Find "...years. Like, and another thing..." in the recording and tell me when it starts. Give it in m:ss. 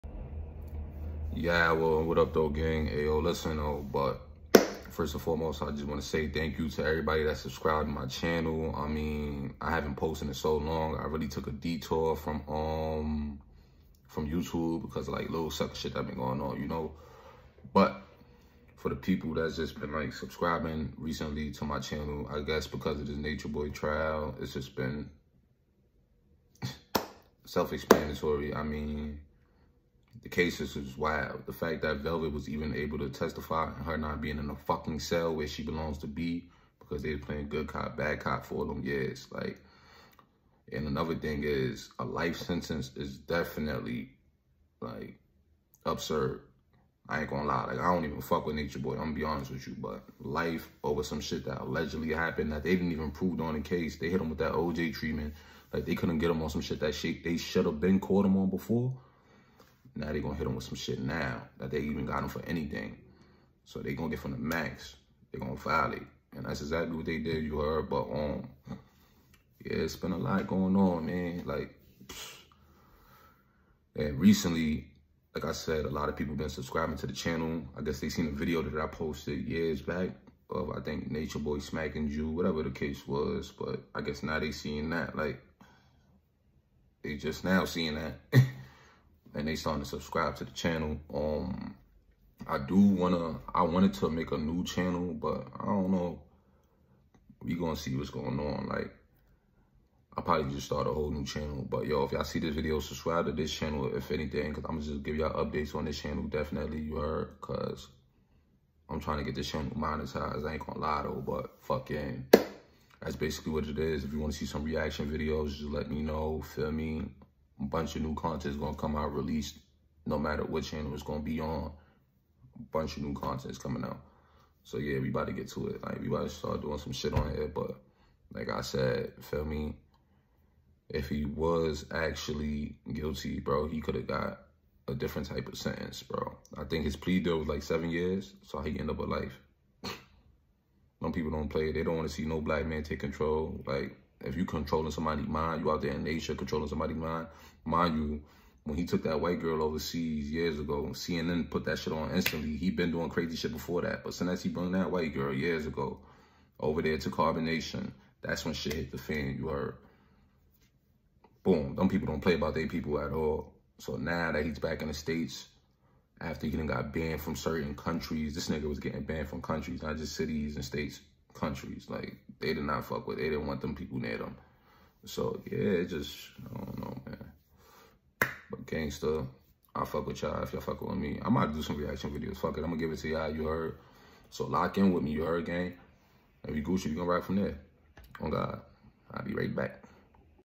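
0:38.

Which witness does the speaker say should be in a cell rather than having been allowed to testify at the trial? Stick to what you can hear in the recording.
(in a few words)
Velvet.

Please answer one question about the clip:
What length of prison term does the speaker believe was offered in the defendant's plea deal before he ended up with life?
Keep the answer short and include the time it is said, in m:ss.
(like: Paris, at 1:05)
7 years, at 2:17.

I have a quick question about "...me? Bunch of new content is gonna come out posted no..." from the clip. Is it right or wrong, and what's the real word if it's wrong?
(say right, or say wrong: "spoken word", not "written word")
wrong: "released", not "posted".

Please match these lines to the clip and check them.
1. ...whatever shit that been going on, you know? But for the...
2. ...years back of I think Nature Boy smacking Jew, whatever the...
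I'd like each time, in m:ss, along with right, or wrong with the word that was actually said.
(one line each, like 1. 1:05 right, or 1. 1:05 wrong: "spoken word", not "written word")
1. 0:15 wrong: "sucker", not "whatever"
2. 1:19 right.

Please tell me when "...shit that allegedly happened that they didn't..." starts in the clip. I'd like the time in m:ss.
0:51.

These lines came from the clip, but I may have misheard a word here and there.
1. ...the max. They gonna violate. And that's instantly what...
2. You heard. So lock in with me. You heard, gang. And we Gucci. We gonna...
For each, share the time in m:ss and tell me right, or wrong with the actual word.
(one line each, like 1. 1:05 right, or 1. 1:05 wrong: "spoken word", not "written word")
1. 1:04 wrong: "exactly", not "instantly"
2. 3:03 right.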